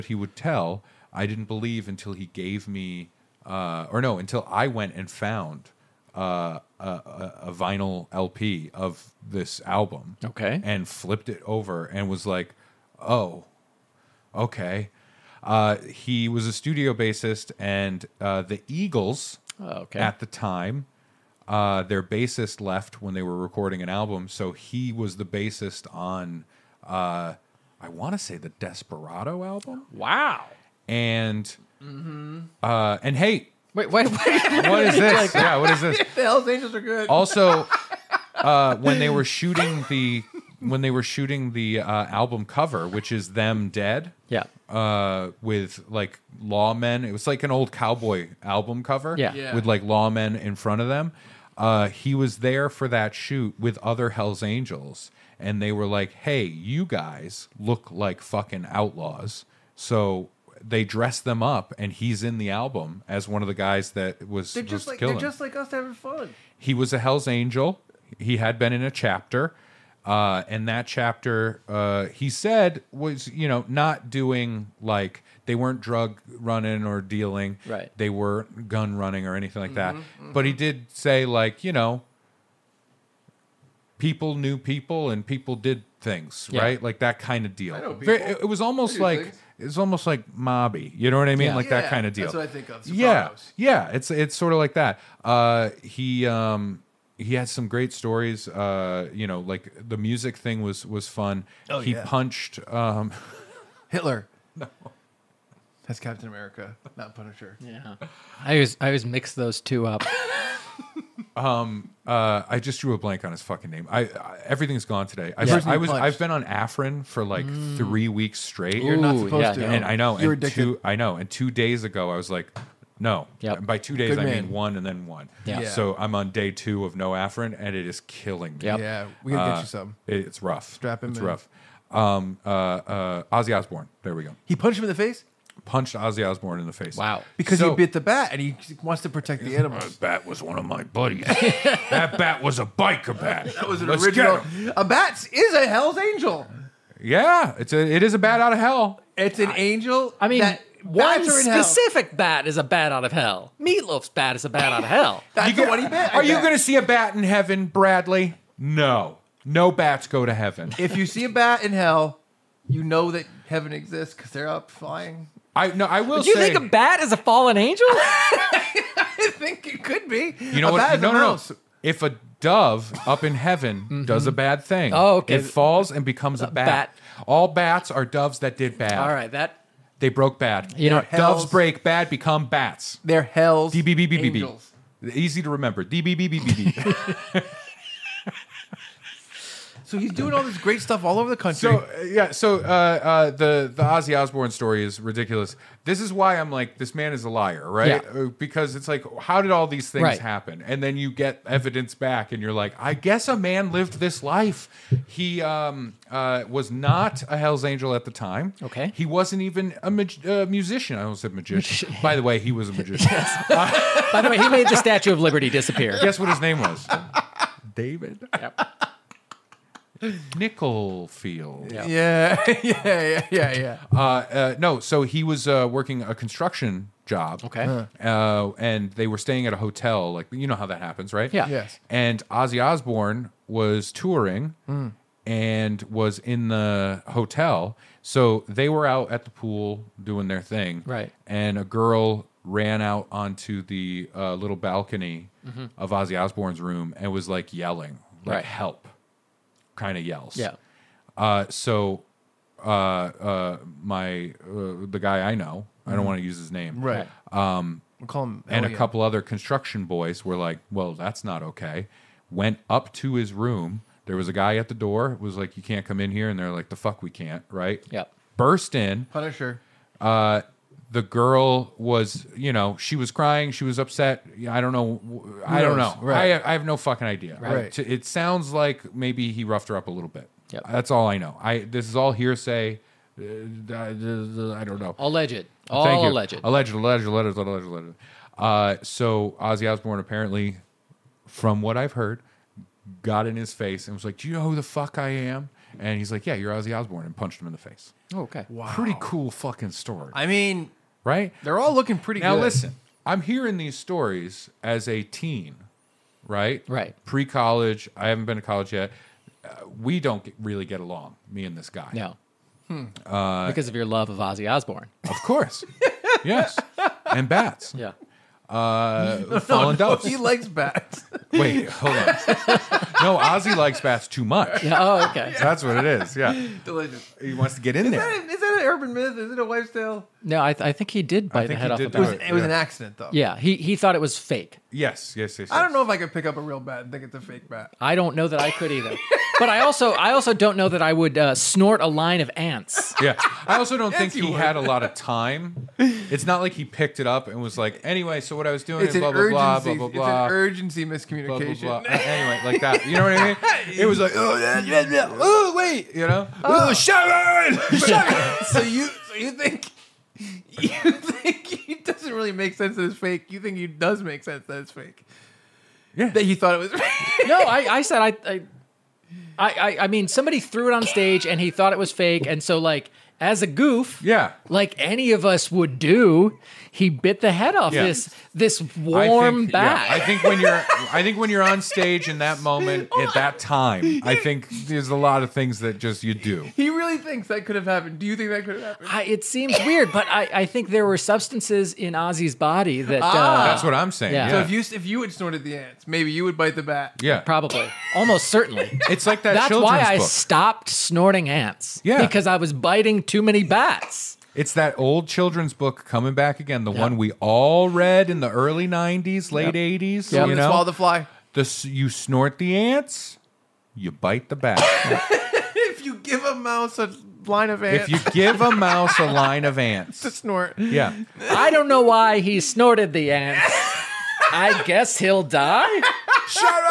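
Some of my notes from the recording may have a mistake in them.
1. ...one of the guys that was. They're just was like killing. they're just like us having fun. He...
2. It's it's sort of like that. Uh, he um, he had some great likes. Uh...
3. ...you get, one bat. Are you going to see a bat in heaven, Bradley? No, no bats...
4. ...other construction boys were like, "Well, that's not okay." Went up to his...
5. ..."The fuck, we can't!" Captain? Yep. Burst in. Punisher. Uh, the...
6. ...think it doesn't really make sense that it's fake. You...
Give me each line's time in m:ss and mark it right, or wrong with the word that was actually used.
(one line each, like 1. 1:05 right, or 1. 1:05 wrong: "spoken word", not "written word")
1. 1:03 right
2. 1:33 wrong: "stories", not "likes"
3. 2:35 right
4. 4:19 right
5. 4:26 wrong: "Right", not "Captain"
6. 6:00 right.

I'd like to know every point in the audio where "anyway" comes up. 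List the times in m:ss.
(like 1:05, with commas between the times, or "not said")
5:47, 5:51.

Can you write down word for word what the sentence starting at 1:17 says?
They were gun running or anything like mm-hmm, that.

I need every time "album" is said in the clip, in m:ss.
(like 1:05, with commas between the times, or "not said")
0:09, 0:23, 0:29, 0:42, 0:48, 1:02.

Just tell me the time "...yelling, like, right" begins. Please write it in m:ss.
4:07.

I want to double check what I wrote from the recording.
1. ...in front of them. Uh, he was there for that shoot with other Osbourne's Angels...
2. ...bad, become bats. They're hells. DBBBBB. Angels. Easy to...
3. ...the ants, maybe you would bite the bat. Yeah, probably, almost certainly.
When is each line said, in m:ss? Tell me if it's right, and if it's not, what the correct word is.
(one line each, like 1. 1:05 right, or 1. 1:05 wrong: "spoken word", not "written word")
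1. 0:50 wrong: "Hell", not "Osbourne"
2. 3:01 right
3. 6:35 right.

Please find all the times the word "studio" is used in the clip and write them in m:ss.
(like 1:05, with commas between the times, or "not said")
0:16.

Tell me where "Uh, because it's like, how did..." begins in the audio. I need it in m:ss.
3:18.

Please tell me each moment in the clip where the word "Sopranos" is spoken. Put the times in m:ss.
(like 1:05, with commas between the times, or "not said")
1:32.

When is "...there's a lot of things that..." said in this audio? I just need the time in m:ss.
6:24.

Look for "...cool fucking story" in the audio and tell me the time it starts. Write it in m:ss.
4:58.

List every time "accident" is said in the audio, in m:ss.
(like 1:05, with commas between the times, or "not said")
5:32.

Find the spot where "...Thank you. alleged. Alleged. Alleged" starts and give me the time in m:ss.
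4:45.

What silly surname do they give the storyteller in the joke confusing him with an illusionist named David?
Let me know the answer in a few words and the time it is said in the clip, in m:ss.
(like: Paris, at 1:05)
Nickelfield, at 3:40.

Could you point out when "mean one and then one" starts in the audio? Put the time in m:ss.
2:04.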